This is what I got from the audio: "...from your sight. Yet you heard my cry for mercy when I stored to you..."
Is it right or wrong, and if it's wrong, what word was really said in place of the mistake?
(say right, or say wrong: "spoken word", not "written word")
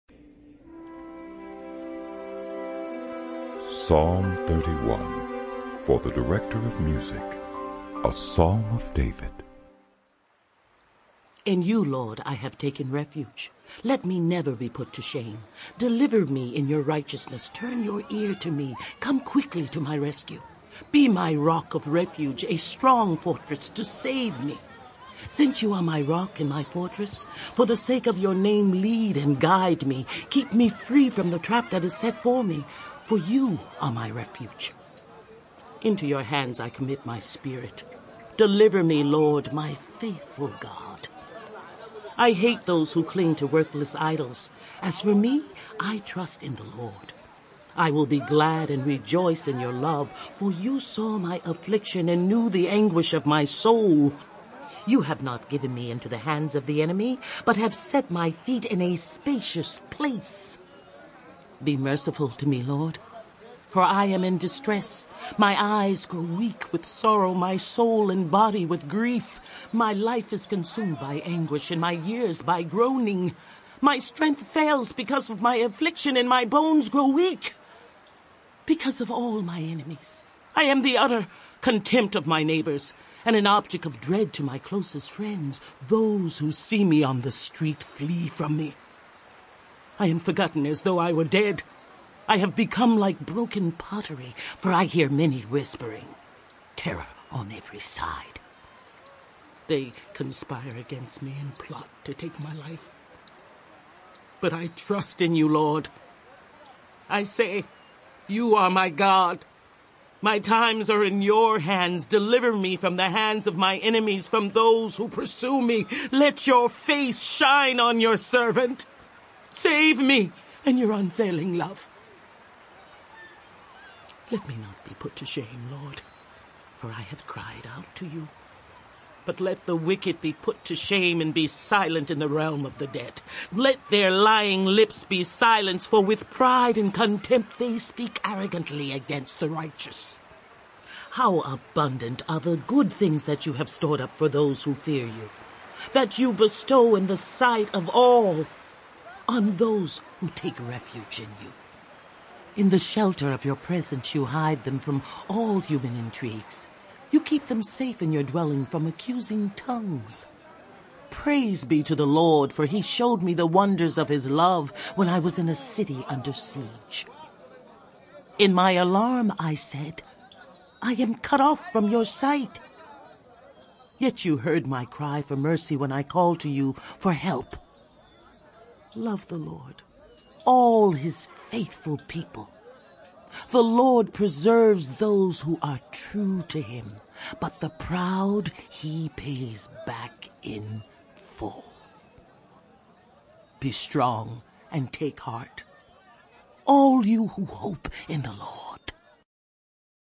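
wrong: "called", not "stored".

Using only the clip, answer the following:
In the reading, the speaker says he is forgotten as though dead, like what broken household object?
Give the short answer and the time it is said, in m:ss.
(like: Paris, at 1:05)
broken pottery, at 1:33.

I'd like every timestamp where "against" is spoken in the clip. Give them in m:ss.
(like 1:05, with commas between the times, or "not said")
1:40, 2:18.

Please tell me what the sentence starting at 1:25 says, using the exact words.
Those who see me on the street flee from me.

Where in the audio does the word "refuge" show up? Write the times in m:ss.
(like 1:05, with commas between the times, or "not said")
0:12, 0:21, 0:34, 2:30.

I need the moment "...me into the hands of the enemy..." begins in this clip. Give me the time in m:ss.
0:55.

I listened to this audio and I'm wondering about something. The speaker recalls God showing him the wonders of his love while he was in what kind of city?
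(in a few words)
a city under siege.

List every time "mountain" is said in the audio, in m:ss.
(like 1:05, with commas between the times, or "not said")
not said.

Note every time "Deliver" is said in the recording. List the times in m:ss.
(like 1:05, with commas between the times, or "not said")
0:15, 0:38, 1:52.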